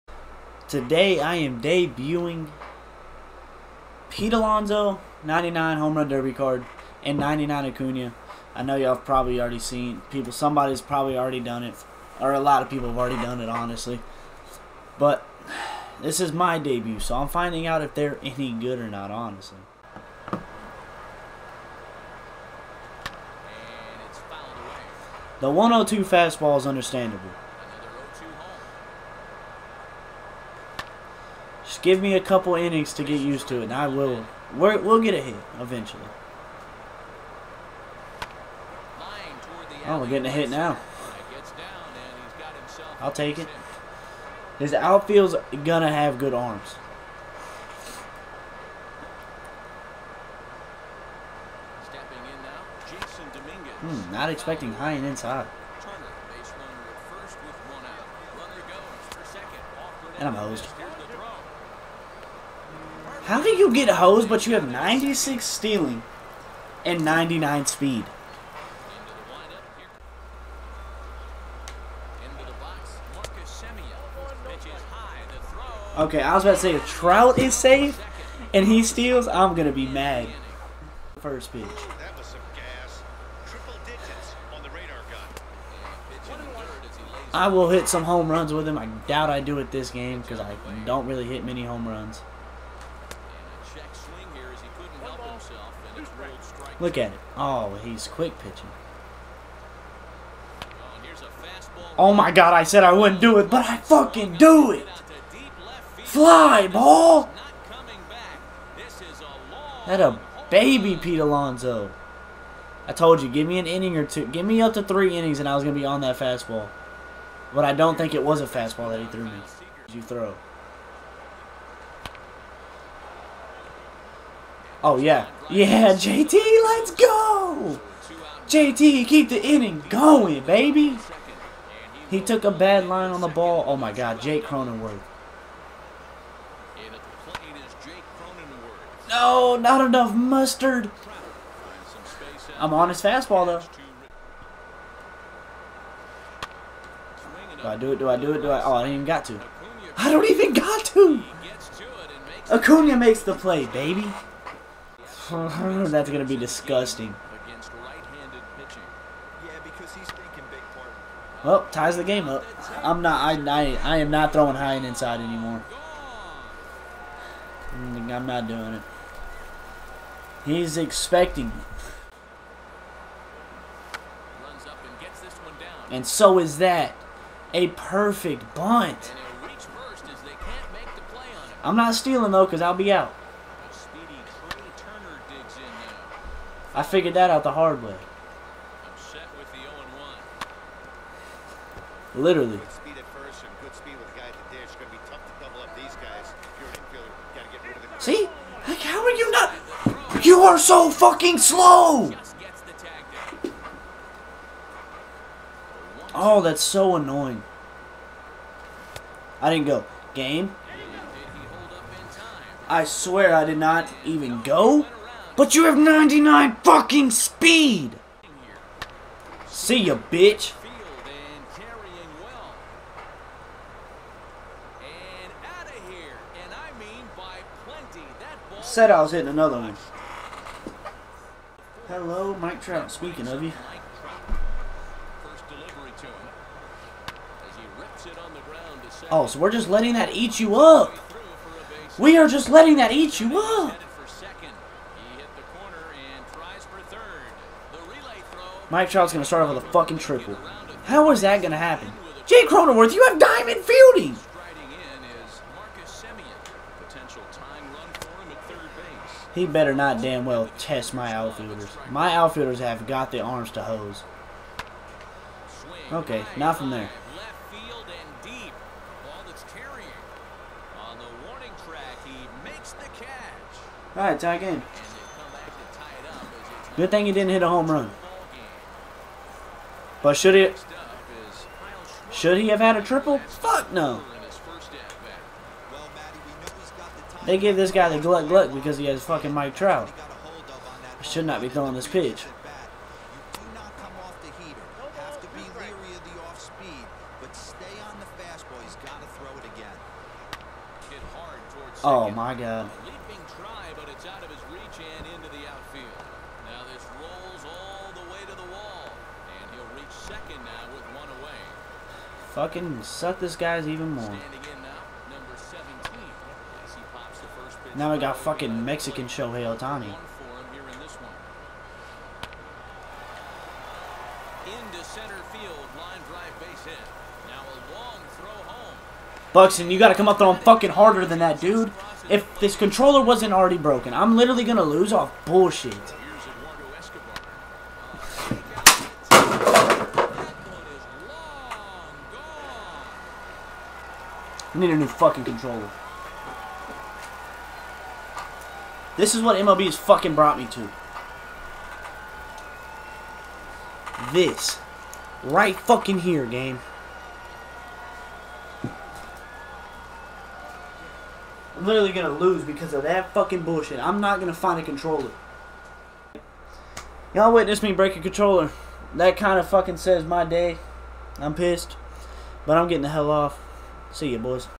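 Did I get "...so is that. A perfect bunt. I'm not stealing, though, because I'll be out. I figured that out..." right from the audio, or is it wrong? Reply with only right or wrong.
right.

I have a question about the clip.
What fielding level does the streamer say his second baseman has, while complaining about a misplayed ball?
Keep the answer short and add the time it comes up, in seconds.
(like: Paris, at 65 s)
diamond, at 253 s.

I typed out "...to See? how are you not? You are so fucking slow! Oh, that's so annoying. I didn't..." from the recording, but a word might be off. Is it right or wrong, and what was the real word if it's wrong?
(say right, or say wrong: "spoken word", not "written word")
right.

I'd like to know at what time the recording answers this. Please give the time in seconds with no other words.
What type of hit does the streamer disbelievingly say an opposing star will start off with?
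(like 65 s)
249 s.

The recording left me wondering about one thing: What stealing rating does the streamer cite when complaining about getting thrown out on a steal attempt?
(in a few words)
96.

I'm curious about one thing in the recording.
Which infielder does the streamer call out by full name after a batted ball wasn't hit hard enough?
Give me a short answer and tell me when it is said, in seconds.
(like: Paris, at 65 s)
Jake Cronenworth, at 134 s.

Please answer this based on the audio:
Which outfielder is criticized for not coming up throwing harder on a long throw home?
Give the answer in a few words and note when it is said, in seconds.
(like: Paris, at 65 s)
Buxton, at 329 s.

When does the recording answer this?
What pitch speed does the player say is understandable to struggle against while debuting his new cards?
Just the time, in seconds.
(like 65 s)
25 s.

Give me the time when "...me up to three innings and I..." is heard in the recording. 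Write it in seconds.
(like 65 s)
114 s.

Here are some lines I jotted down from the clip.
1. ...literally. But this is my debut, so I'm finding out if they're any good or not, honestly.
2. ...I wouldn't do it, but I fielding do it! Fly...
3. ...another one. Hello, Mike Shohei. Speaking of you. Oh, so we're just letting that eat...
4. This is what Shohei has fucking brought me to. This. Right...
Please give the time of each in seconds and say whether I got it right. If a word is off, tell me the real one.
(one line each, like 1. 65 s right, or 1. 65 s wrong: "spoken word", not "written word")
1. 13 s wrong: "honestly", not "literally"
2. 102 s wrong: "fucking", not "fielding"
3. 229 s wrong: "Trout", not "Shohei"
4. 348 s wrong: "MLB", not "Shohei".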